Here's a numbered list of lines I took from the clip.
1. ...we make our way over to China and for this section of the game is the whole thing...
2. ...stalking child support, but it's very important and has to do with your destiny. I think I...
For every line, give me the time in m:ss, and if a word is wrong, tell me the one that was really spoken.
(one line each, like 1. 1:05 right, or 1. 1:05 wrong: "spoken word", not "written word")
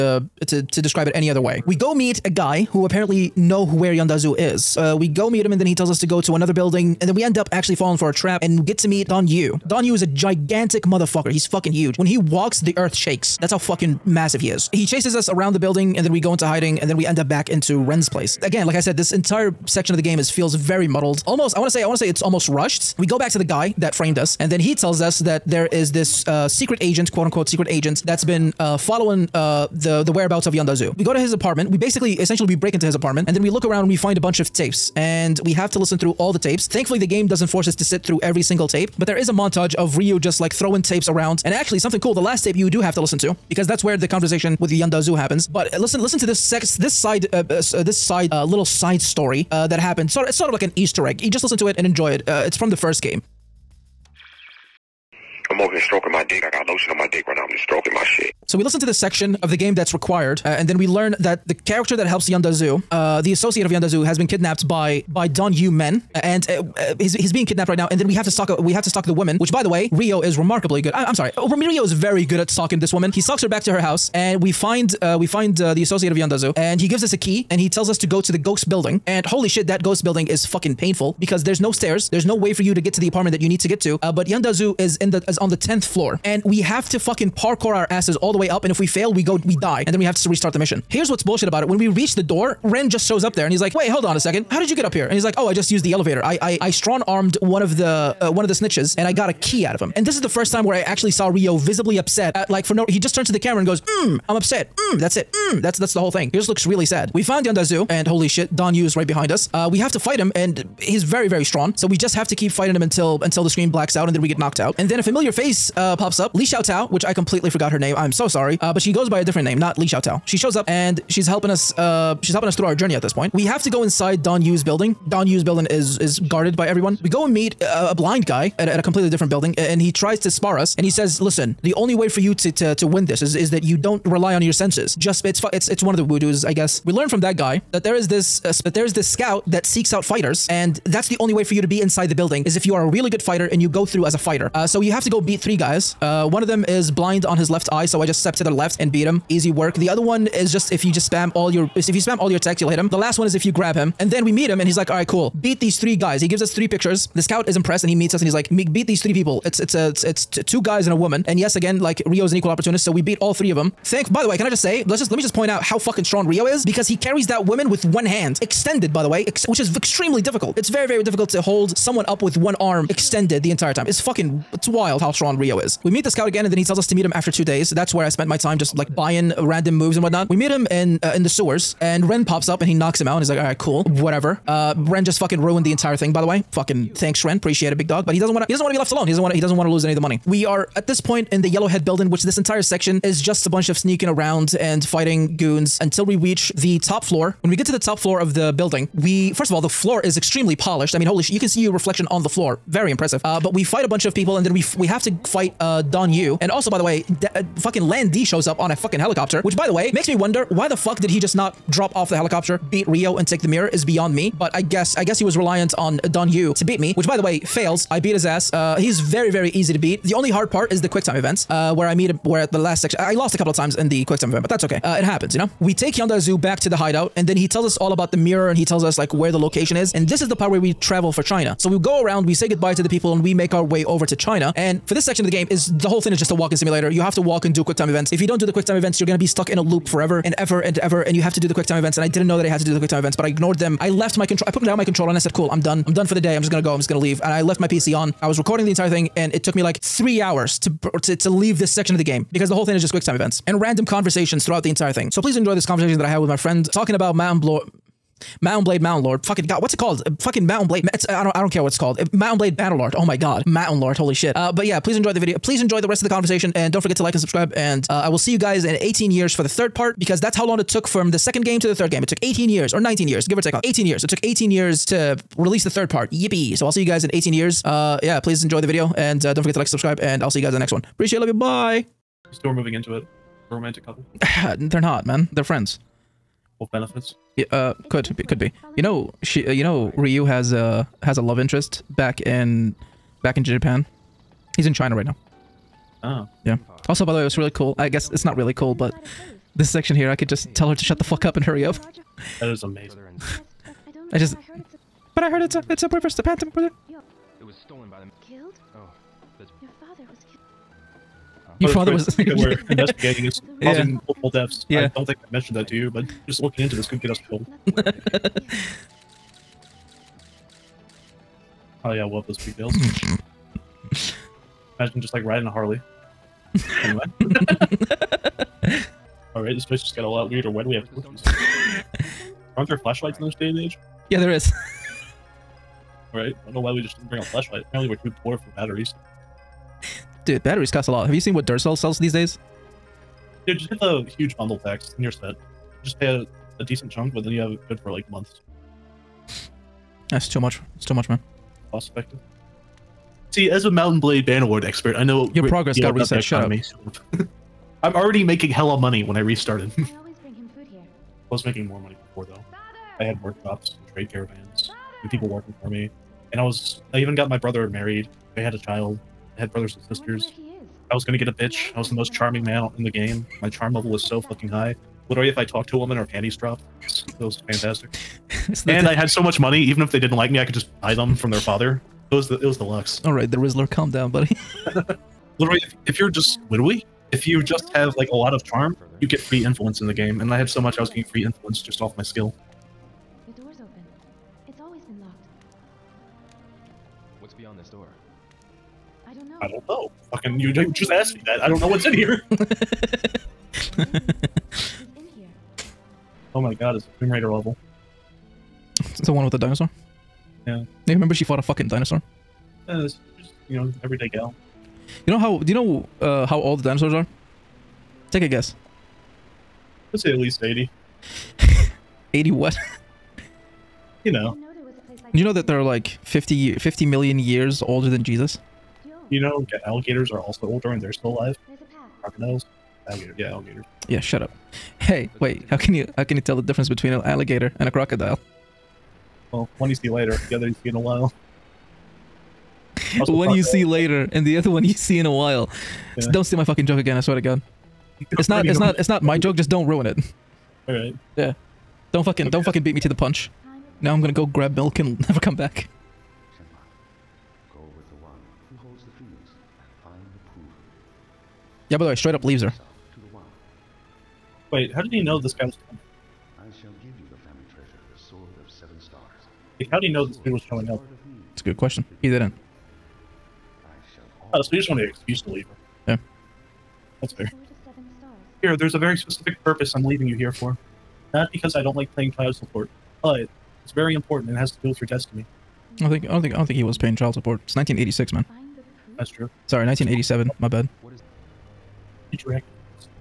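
1. 3:53 right
2. 8:01 wrong: "playing", not "stalking".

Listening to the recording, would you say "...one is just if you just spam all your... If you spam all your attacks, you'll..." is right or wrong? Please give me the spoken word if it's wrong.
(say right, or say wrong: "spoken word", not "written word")
right.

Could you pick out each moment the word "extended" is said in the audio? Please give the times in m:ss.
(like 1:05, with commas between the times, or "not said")
2:48, 2:52.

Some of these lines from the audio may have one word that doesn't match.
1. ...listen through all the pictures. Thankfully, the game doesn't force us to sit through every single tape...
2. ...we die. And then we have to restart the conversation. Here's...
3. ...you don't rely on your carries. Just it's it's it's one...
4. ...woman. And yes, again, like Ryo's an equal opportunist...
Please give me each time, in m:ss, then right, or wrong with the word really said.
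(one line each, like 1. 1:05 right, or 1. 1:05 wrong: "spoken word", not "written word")
1. 0:35 wrong: "tapes", not "pictures"
2. 1:29 wrong: "mission", not "conversation"
3. 2:13 wrong: "senses", not "carries"
4. 2:40 right.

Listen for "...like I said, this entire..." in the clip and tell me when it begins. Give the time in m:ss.
0:18.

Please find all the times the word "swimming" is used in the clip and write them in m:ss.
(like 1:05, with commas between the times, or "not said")
not said.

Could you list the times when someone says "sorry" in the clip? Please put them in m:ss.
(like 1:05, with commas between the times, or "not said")
1:11, 1:58, 8:09.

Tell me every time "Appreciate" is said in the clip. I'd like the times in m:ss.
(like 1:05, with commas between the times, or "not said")
3:07, 4:40.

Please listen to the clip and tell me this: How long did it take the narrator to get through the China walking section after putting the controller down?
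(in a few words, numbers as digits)
3 hours.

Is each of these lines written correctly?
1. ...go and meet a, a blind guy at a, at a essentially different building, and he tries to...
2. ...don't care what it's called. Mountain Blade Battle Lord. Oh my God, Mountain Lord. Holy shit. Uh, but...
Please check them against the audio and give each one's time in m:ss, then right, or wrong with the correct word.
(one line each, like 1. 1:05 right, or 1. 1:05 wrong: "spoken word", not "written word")
1. 2:07 wrong: "completely", not "essentially"
2. 4:21 right.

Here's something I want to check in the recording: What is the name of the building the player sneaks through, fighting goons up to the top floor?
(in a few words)
Yellowhead building.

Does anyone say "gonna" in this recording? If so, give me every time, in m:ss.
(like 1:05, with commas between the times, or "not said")
6:11, 7:34.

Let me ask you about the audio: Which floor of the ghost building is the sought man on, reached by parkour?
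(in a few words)
10th floor.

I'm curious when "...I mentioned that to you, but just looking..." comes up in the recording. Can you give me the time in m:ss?
5:15.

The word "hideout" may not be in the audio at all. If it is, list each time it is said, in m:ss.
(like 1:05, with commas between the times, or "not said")
3:46.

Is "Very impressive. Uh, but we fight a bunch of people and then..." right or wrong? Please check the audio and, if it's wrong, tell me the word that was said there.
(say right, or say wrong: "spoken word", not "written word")
right.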